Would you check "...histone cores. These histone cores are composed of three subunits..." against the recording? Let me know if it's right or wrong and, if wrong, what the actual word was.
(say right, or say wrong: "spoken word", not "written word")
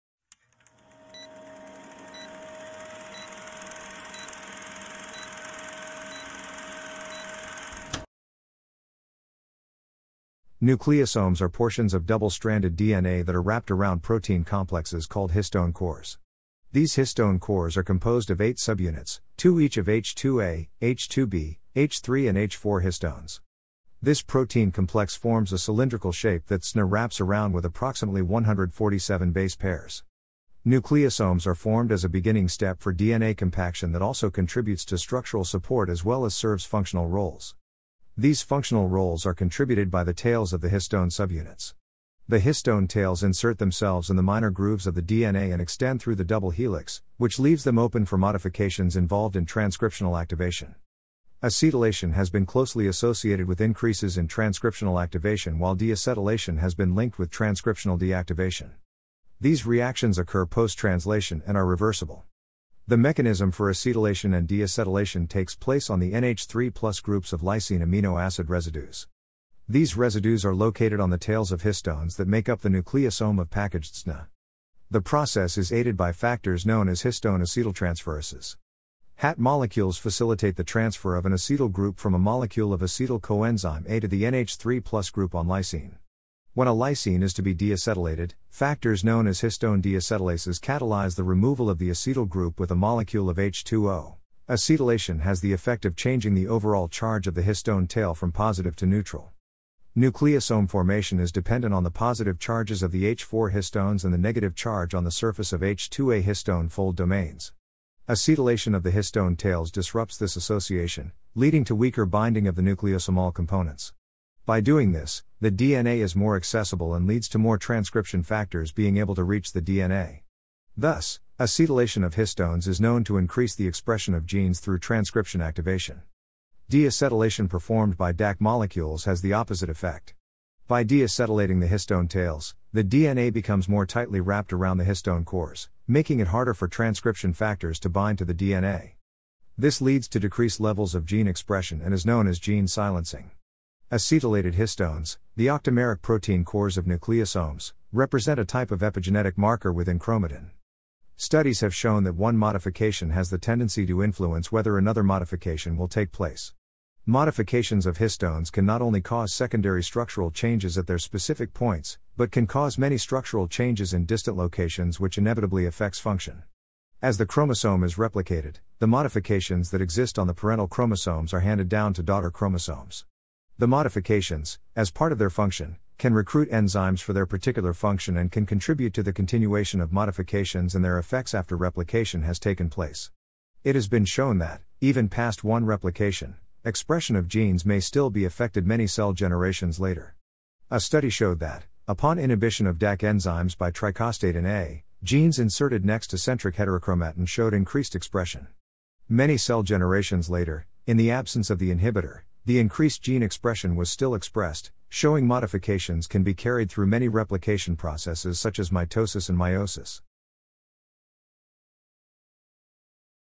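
wrong: "eight", not "three".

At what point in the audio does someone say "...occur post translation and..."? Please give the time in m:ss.
1:00.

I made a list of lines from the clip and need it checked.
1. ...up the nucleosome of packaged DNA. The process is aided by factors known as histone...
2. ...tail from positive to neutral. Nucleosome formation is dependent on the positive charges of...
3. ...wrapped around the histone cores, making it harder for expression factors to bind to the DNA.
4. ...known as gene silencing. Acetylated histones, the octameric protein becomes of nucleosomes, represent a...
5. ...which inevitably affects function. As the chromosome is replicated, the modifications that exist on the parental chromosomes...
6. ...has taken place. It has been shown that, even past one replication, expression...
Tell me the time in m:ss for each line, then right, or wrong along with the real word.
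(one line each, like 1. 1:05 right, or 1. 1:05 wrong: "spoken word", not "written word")
1. 1:12 right
2. 1:37 right
3. 2:14 wrong: "transcription", not "expression"
4. 2:22 wrong: "cores", not "becomes"
5. 2:45 right
6. 3:02 right.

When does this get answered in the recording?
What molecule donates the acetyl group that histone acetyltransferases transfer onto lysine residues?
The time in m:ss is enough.
1:22.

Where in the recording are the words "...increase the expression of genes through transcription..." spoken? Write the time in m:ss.
2:03.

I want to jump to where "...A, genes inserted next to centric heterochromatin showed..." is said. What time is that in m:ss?
3:14.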